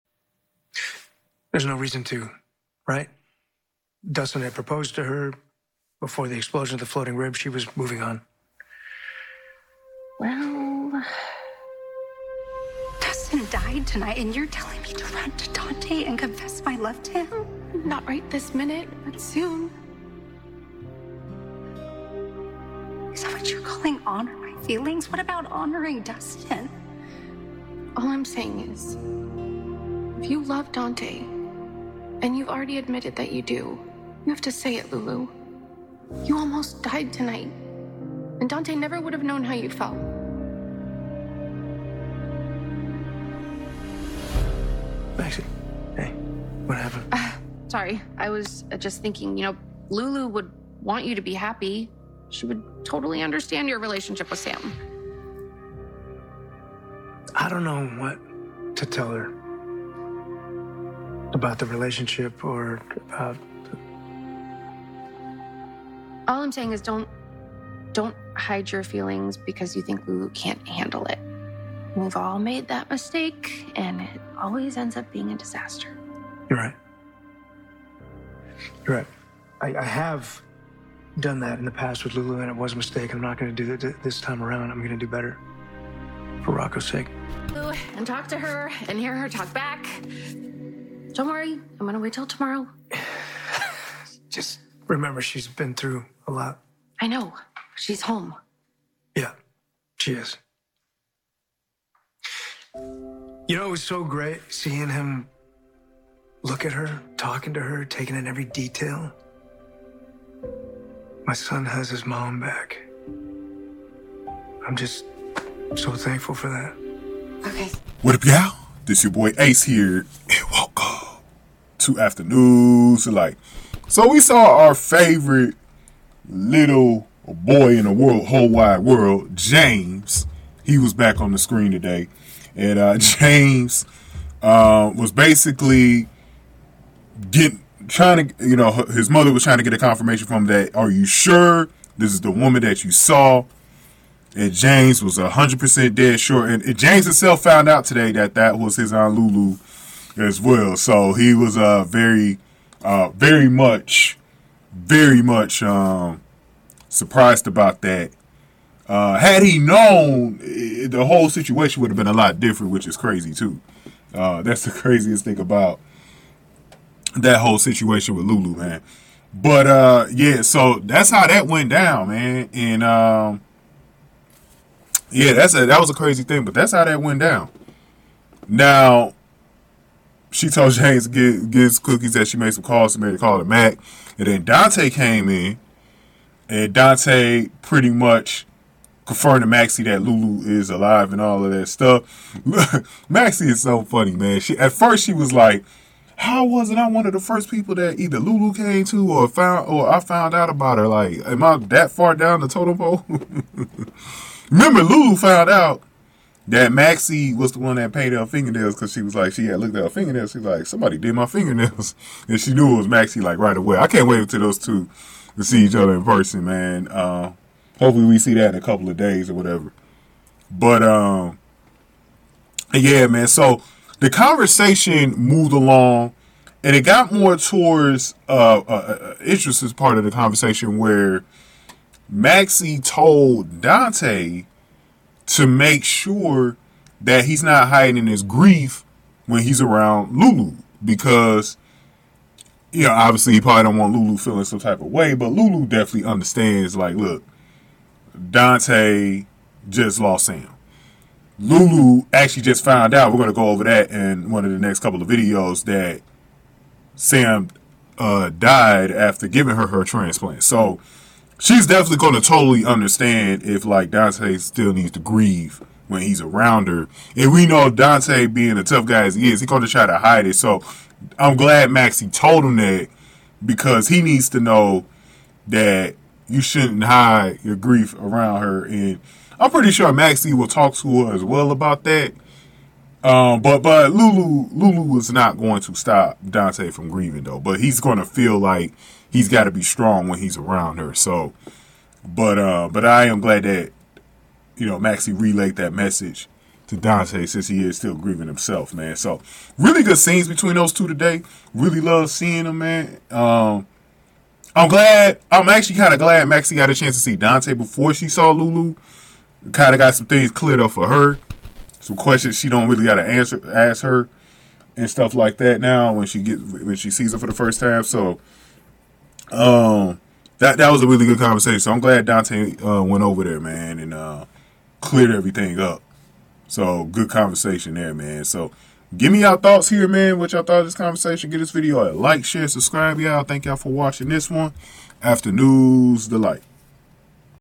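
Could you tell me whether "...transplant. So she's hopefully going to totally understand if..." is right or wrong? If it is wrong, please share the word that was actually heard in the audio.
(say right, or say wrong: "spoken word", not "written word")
wrong: "definitely", not "hopefully".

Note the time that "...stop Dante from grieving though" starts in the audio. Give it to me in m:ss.
4:45.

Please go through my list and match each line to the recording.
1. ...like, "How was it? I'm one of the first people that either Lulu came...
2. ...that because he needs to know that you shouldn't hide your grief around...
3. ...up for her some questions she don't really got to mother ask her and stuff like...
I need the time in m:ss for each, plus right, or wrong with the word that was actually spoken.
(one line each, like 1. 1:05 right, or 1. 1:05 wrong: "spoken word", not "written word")
1. 3:15 right
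2. 4:32 right
3. 5:10 wrong: "answer", not "mother".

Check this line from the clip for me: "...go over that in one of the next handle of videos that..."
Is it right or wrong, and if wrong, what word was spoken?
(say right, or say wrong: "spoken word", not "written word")
wrong: "couple", not "handle".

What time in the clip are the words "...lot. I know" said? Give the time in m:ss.
1:36.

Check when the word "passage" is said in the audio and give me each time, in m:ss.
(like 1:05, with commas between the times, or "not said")
not said.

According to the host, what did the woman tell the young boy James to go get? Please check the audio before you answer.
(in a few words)
His cookies.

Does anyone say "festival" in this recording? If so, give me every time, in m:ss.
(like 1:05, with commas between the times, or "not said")
not said.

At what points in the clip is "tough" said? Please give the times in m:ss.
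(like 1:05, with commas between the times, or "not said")
4:28.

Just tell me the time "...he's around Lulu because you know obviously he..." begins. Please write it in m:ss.
3:59.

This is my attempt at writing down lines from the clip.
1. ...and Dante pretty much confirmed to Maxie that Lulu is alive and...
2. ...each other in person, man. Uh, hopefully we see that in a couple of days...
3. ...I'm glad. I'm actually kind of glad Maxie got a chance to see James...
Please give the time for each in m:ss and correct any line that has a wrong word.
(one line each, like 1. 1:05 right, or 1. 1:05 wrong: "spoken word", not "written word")
1. 3:06 right
2. 3:35 right
3. 5:04 wrong: "Dante", not "James".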